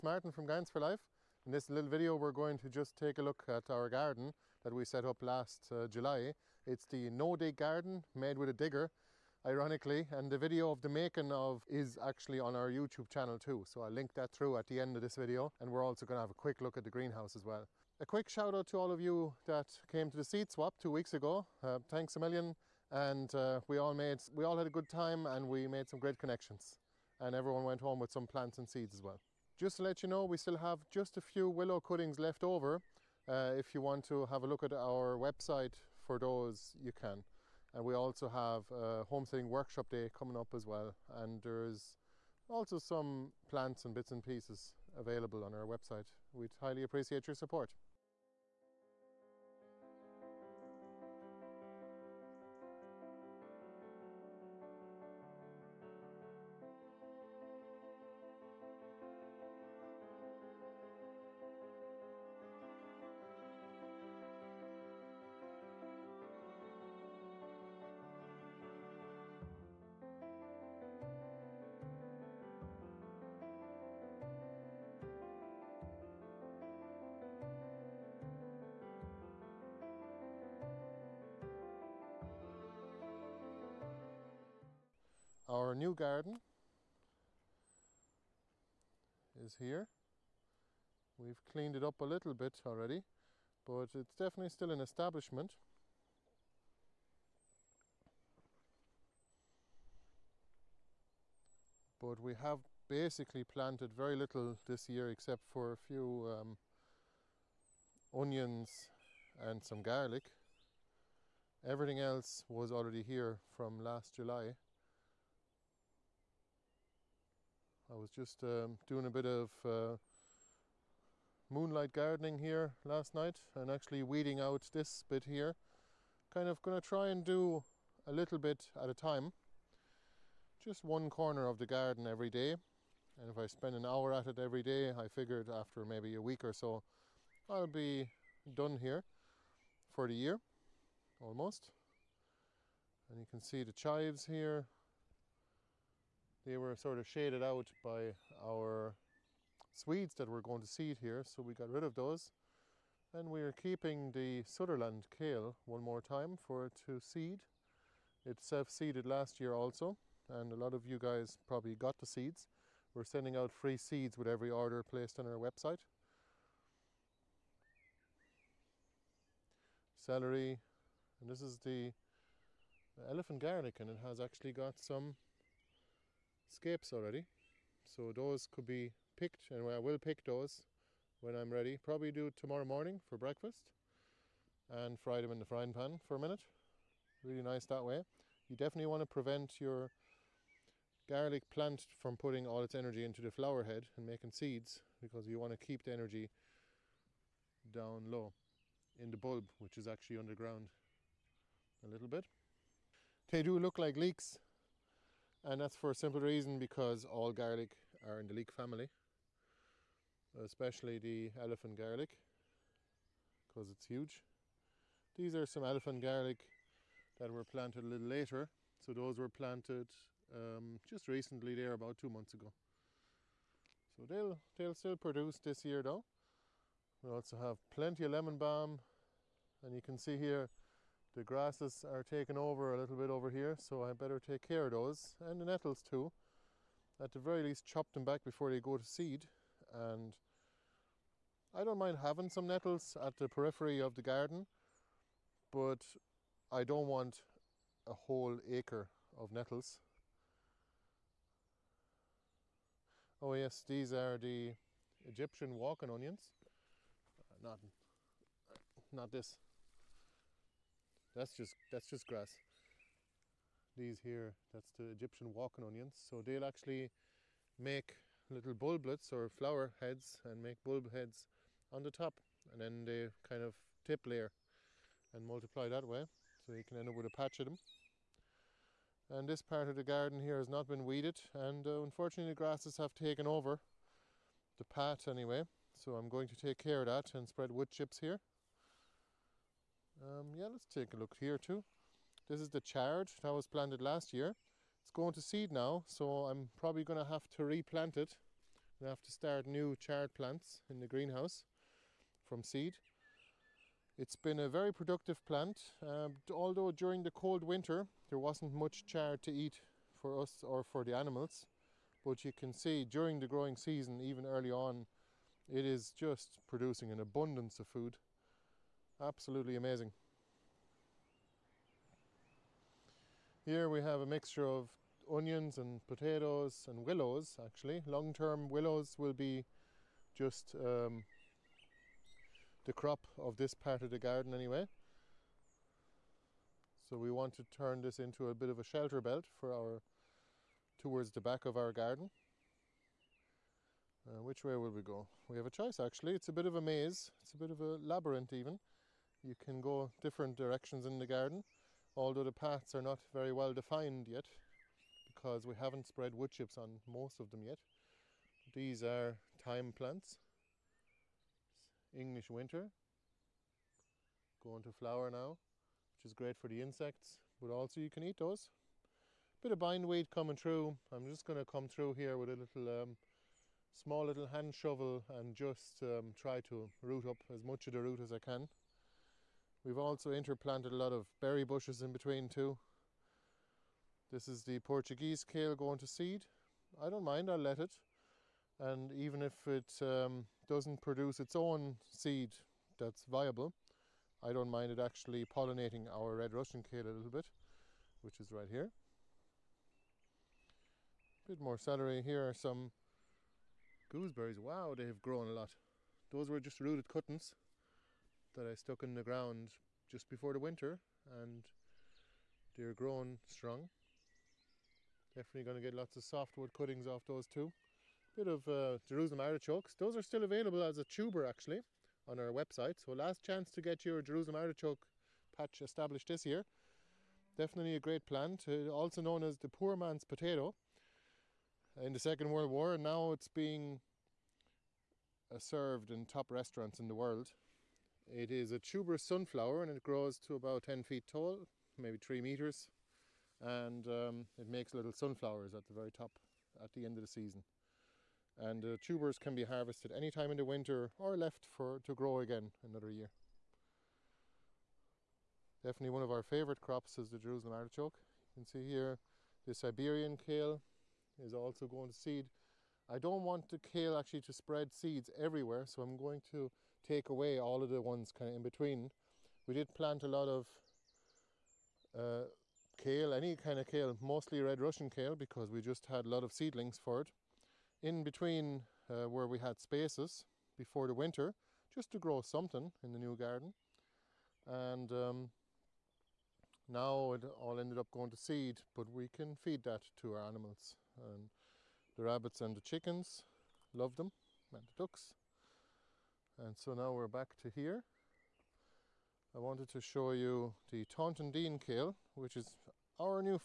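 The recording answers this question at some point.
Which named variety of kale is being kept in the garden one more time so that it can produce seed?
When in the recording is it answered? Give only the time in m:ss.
2:34.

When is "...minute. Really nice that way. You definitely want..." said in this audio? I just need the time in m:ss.
3:06.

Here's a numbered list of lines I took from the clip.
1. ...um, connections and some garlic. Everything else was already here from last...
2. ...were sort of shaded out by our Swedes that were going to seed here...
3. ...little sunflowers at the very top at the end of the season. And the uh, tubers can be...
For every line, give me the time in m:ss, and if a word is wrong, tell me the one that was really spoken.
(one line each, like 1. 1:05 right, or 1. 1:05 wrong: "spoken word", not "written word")
1. 1:46 wrong: "onions", not "connections"
2. 2:26 right
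3. 7:24 right.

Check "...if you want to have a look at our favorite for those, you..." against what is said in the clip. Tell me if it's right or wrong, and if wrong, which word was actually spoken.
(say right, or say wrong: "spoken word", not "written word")
wrong: "website", not "favorite".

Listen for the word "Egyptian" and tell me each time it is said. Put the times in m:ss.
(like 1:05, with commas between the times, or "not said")
4:14, 4:24.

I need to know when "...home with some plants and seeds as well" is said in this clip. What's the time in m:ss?
0:27.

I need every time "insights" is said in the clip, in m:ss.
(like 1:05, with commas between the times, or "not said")
not said.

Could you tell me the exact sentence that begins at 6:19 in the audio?
We've also interplanted a lot of berry bushes in between too.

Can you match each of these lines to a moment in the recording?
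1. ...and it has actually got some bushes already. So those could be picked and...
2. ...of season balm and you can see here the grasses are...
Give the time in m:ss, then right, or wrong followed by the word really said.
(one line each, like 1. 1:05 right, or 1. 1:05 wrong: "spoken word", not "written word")
1. 2:53 wrong: "scapes", not "bushes"
2. 3:48 wrong: "lemon", not "season".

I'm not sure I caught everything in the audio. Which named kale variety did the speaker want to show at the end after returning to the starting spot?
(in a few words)
Taunton Deane kale.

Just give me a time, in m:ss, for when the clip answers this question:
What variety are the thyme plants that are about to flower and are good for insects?
6:01.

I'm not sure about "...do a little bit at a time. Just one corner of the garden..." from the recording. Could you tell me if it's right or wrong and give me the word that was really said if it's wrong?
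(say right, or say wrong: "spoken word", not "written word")
right.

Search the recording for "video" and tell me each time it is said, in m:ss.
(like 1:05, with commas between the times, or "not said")
0:01, 0:10, 0:15.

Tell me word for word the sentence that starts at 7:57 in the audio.
In between uh, where we had spaces before the winter, just to grow something in the new garden.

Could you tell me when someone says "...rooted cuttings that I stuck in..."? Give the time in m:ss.
6:46.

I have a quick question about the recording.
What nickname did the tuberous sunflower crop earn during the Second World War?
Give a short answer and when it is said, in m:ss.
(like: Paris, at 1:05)
Poor man's potato, at 7:09.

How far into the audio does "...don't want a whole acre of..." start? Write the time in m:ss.
4:06.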